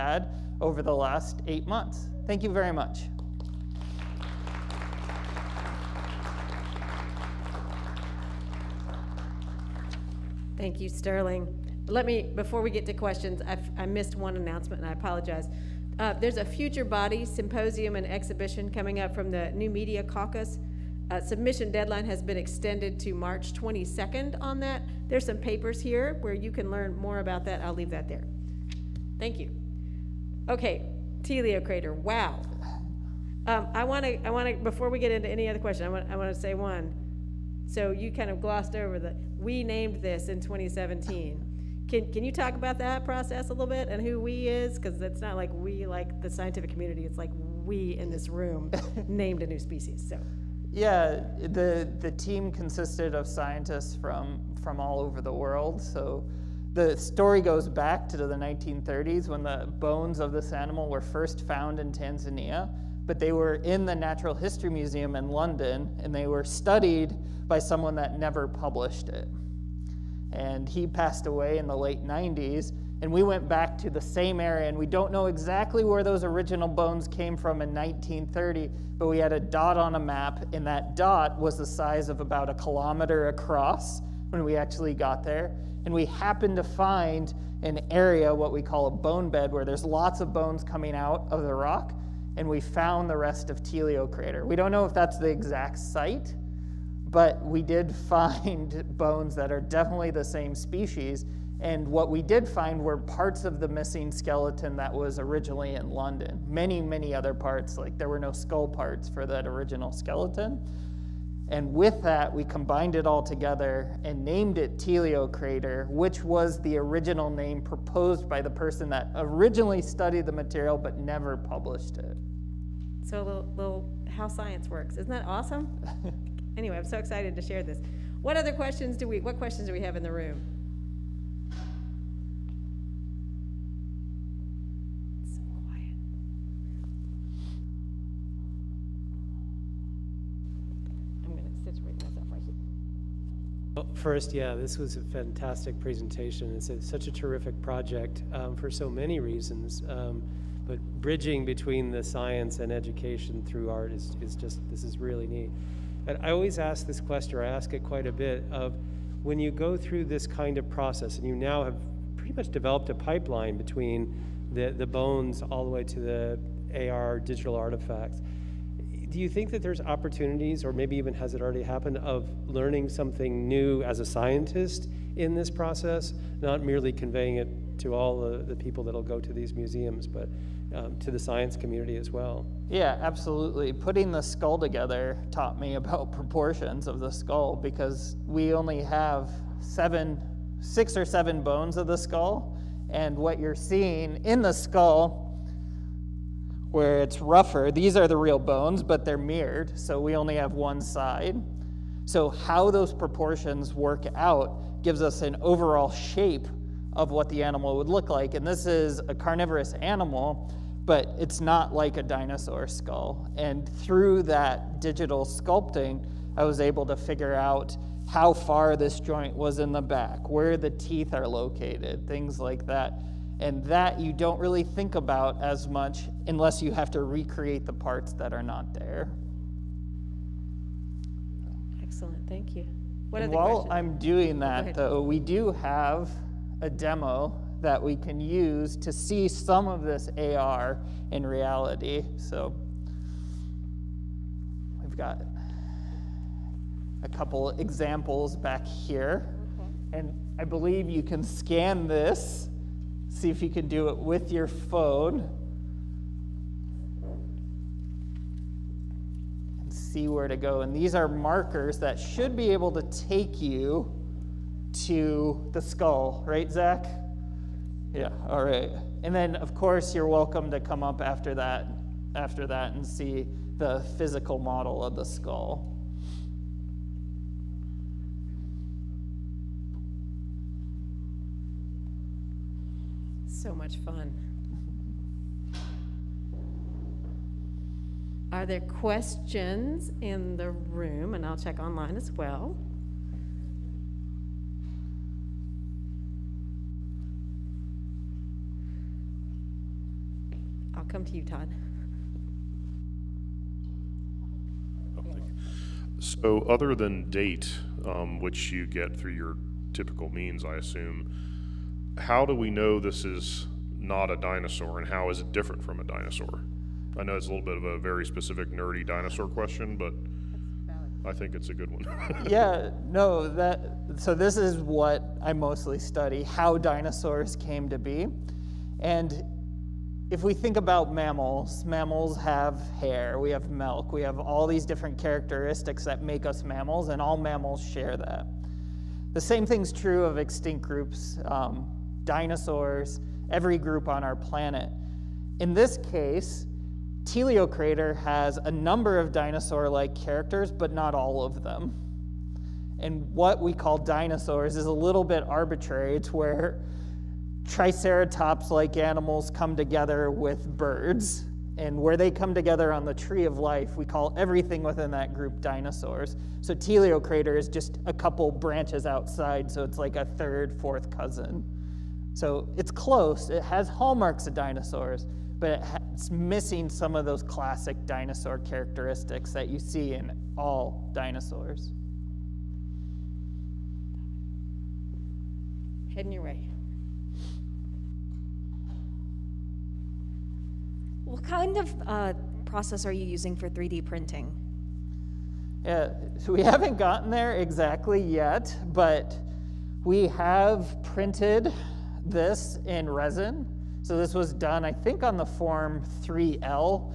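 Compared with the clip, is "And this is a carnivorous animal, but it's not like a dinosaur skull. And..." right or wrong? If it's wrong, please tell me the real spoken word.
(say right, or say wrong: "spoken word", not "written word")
right.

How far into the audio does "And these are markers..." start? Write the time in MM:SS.
04:20.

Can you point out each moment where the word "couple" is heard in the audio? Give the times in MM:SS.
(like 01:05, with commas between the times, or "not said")
04:07, 06:07.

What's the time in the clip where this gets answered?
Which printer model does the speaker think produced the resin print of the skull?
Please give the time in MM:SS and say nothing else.
06:45.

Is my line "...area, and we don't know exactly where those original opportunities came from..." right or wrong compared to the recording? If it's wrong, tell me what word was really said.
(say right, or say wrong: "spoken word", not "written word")
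wrong: "bones", not "opportunities".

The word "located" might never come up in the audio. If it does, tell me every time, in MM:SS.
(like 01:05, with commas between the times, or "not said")
03:41.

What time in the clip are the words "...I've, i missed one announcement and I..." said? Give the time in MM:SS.
00:13.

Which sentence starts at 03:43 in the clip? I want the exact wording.
And that you don't really think about as much unless you have to recreate the parts that are not there.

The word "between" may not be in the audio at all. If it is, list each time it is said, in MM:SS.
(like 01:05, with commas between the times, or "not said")
02:31, 02:43.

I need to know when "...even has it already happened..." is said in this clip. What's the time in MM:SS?
02:50.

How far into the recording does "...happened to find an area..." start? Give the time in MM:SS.
01:26.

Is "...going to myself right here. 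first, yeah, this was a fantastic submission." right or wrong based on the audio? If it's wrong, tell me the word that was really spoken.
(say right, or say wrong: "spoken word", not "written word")
wrong: "presentation", not "submission".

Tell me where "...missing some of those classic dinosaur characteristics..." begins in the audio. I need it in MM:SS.
06:16.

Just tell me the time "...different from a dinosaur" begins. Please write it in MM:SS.
05:15.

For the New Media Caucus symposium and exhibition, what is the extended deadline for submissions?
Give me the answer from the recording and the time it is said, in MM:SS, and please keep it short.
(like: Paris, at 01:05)
March 22nd, at 00:23.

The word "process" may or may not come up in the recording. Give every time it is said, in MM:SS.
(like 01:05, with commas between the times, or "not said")
00:43, 02:40, 02:55, 06:32.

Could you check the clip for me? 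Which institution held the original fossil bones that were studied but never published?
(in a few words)
Natural History Museum in London.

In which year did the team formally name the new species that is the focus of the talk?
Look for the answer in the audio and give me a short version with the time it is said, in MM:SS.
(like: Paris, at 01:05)
2017, at 00:40.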